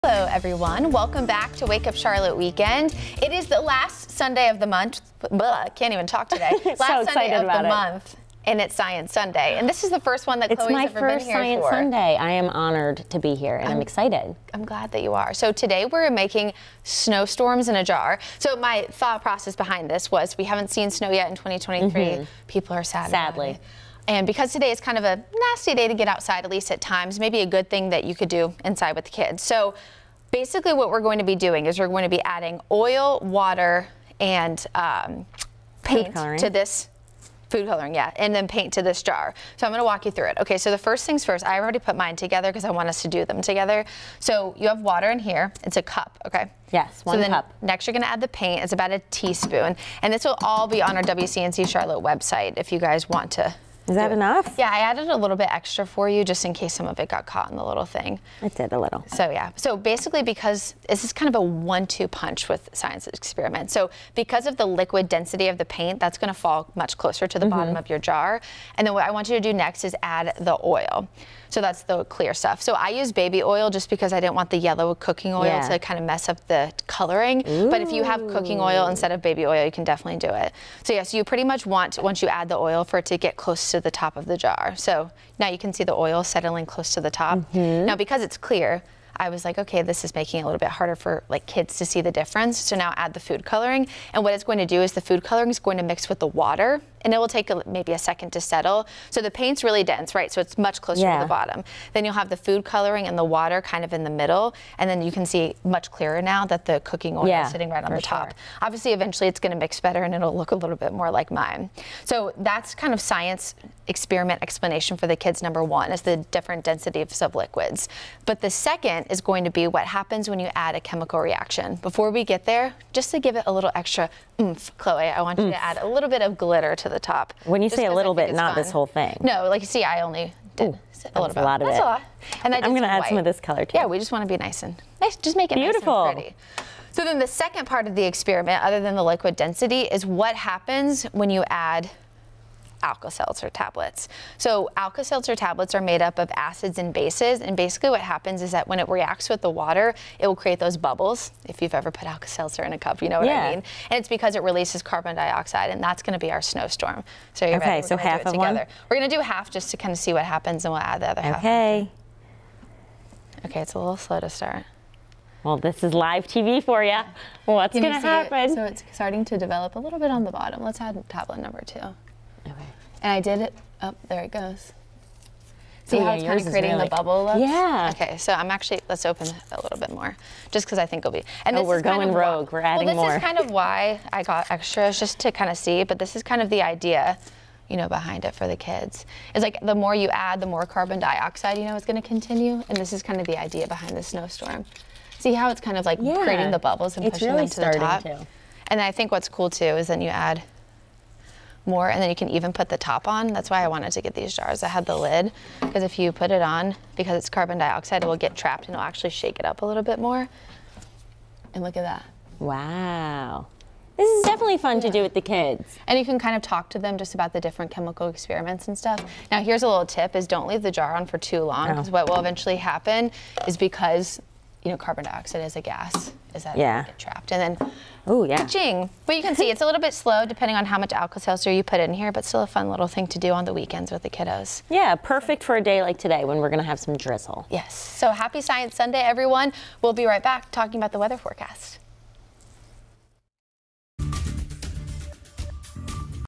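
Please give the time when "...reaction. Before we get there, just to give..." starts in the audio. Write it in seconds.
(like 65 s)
121 s.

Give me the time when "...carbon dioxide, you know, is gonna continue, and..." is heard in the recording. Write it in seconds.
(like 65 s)
190 s.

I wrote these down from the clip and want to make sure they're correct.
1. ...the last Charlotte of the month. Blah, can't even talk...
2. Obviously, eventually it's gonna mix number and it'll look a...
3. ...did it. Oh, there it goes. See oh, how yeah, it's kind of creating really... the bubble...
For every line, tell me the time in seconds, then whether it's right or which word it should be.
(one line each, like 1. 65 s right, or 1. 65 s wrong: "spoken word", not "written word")
1. 3 s wrong: "Sunday", not "Charlotte"
2. 108 s wrong: "better", not "number"
3. 173 s right.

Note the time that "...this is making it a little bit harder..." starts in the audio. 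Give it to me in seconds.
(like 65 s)
89 s.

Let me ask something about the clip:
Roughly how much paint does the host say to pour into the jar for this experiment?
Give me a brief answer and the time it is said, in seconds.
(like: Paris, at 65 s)
1 teaspoon, at 48 s.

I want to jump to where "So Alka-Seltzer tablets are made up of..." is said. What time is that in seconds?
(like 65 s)
144 s.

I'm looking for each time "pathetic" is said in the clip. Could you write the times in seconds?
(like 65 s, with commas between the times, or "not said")
not said.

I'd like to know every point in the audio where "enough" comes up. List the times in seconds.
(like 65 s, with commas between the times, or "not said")
54 s.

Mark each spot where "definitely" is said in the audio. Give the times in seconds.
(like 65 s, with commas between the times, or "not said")
79 s, 214 s.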